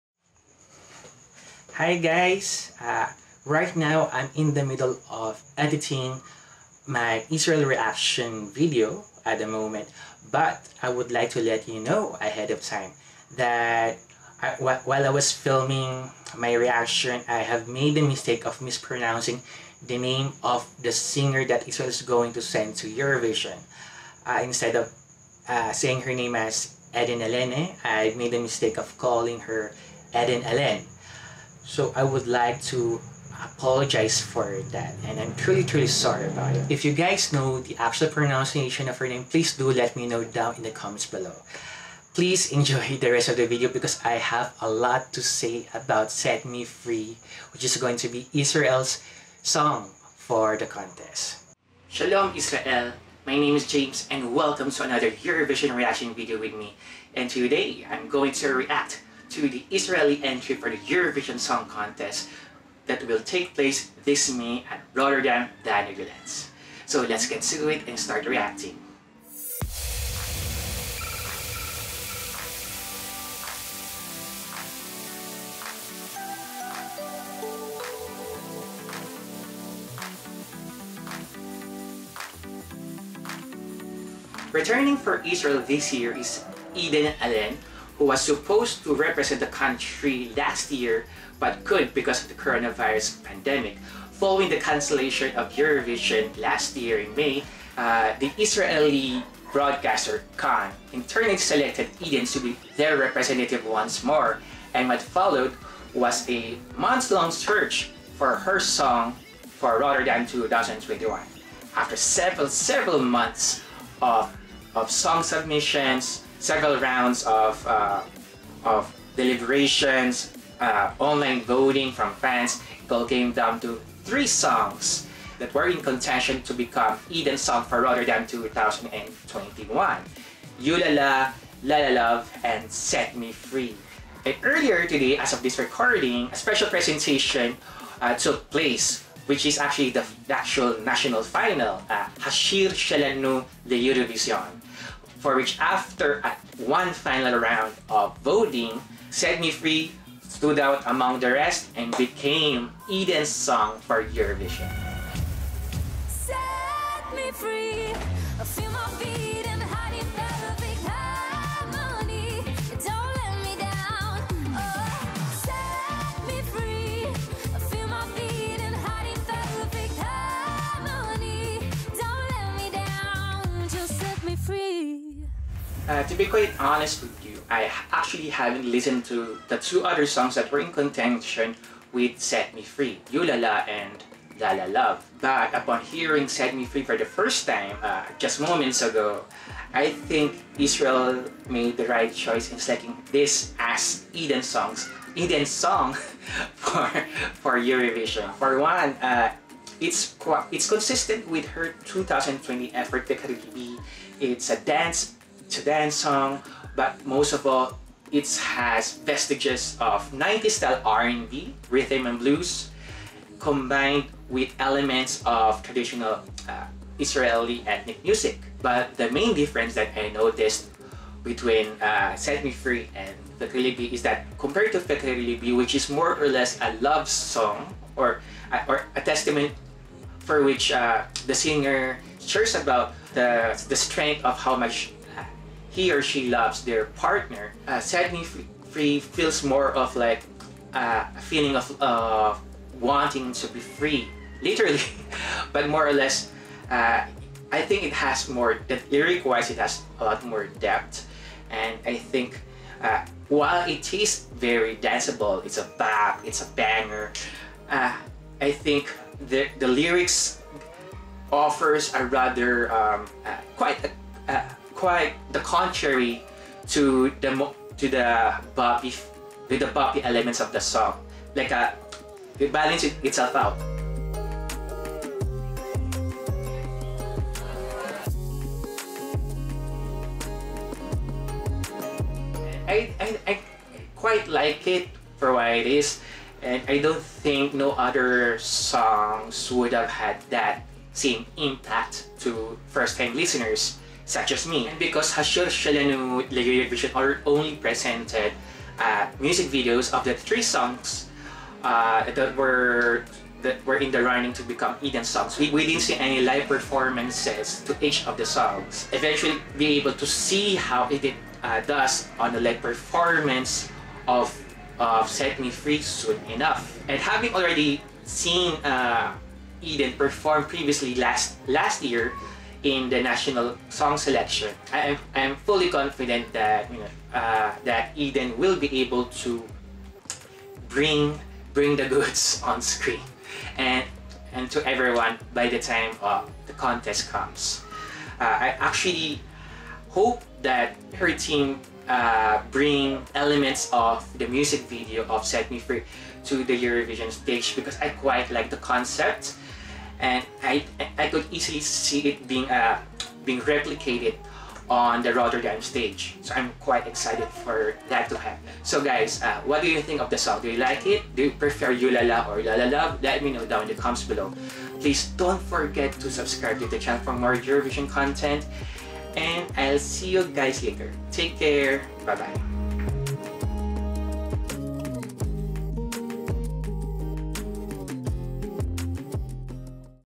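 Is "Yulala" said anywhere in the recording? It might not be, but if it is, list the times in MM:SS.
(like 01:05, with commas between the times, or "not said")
02:10, 03:03, 06:01.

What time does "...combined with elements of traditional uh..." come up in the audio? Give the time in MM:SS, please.
03:33.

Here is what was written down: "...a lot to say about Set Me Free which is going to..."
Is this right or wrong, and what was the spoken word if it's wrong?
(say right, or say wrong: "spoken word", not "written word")
right.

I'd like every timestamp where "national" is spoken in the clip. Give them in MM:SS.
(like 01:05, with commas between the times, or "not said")
02:20, 05:23.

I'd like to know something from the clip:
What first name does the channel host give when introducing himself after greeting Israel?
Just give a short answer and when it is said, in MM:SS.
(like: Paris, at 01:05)
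James, at 00:53.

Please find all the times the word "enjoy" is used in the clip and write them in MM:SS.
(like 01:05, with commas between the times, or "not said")
00:42.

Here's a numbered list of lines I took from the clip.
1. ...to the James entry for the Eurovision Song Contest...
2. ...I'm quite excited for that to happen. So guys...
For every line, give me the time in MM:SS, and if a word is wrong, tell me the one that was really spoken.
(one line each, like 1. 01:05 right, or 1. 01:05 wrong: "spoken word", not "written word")
1. 00:59 wrong: "Israeli", not "James"
2. 05:56 right.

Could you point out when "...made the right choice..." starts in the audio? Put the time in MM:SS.
03:11.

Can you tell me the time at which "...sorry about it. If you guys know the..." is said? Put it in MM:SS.
00:35.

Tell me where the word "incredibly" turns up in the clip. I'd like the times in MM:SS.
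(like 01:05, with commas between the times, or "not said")
not said.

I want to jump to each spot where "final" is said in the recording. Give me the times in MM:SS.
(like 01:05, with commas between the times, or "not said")
02:21, 02:26.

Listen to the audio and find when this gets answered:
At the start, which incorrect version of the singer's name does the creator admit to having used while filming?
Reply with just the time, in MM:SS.
00:30.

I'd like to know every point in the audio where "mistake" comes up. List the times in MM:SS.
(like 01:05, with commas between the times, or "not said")
00:18, 00:28.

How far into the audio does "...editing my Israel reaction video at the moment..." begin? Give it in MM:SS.
00:05.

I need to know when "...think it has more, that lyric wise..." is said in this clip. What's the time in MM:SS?
04:07.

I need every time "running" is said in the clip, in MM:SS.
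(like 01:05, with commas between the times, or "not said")
05:04.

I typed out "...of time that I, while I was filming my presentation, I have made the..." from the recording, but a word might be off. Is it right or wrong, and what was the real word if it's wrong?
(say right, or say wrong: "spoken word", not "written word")
wrong: "reaction", not "presentation".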